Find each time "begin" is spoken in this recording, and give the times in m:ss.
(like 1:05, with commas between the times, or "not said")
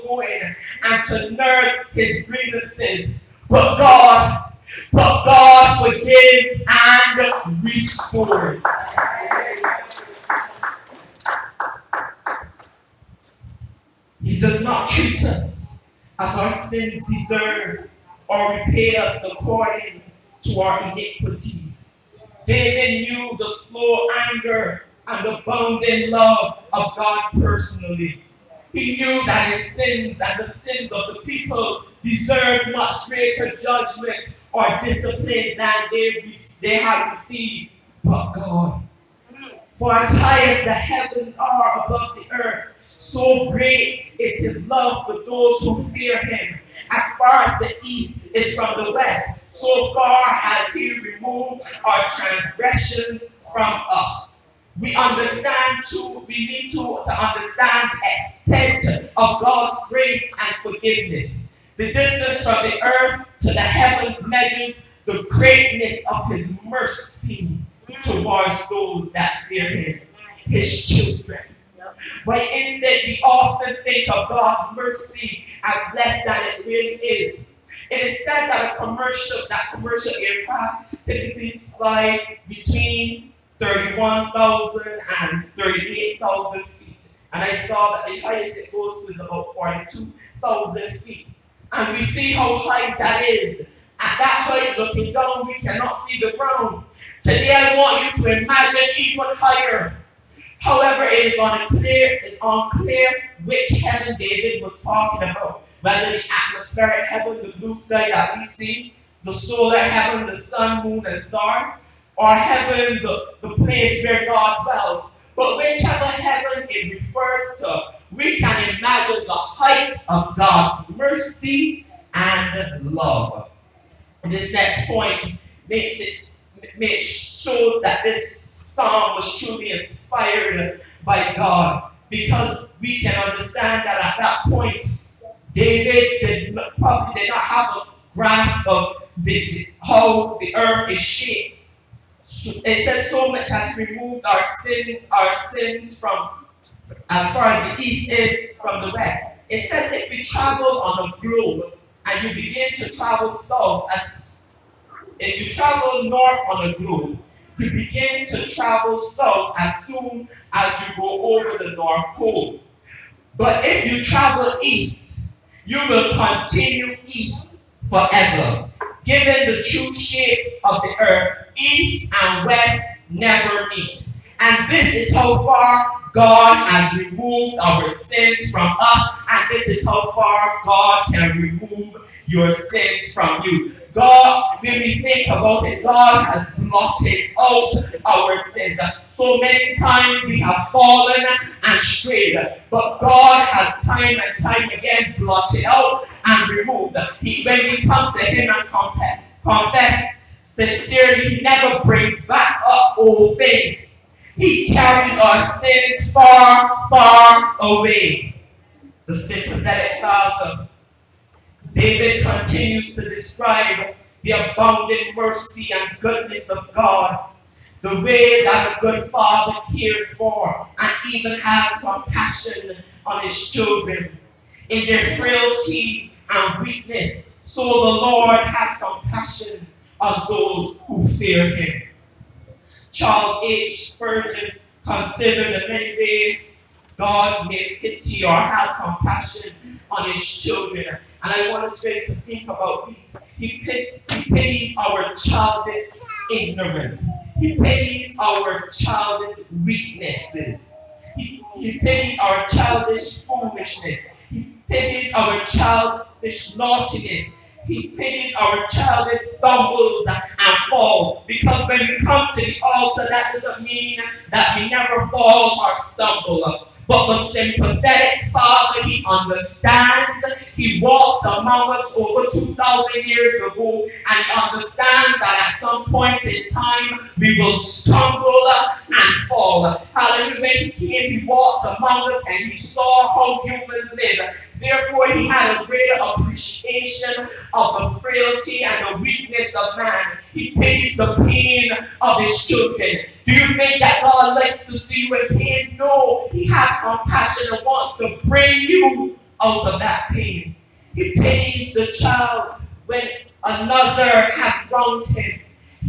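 2:32, 2:37.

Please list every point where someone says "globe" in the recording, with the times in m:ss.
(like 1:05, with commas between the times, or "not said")
2:31, 2:36.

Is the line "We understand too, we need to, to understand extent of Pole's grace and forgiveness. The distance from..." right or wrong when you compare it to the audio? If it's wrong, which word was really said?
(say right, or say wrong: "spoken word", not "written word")
wrong: "God", not "Pole".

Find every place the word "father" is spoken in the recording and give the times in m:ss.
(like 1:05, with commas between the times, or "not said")
3:30, 3:39, 4:28.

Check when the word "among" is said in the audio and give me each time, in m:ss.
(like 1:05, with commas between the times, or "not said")
4:31, 4:41.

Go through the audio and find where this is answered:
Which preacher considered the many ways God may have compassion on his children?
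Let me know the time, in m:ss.
3:52.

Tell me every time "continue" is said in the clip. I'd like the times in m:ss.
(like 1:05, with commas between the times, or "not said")
2:46, 3:32.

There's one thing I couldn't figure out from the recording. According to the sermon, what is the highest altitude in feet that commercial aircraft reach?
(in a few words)
42,000.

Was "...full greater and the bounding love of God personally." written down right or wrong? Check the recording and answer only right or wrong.
wrong.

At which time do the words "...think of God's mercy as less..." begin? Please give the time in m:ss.
1:13.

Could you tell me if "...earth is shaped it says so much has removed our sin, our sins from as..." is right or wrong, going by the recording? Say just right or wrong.
right.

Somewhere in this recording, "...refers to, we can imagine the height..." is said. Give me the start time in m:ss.
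1:56.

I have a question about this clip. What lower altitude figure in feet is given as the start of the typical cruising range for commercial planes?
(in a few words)
31,000.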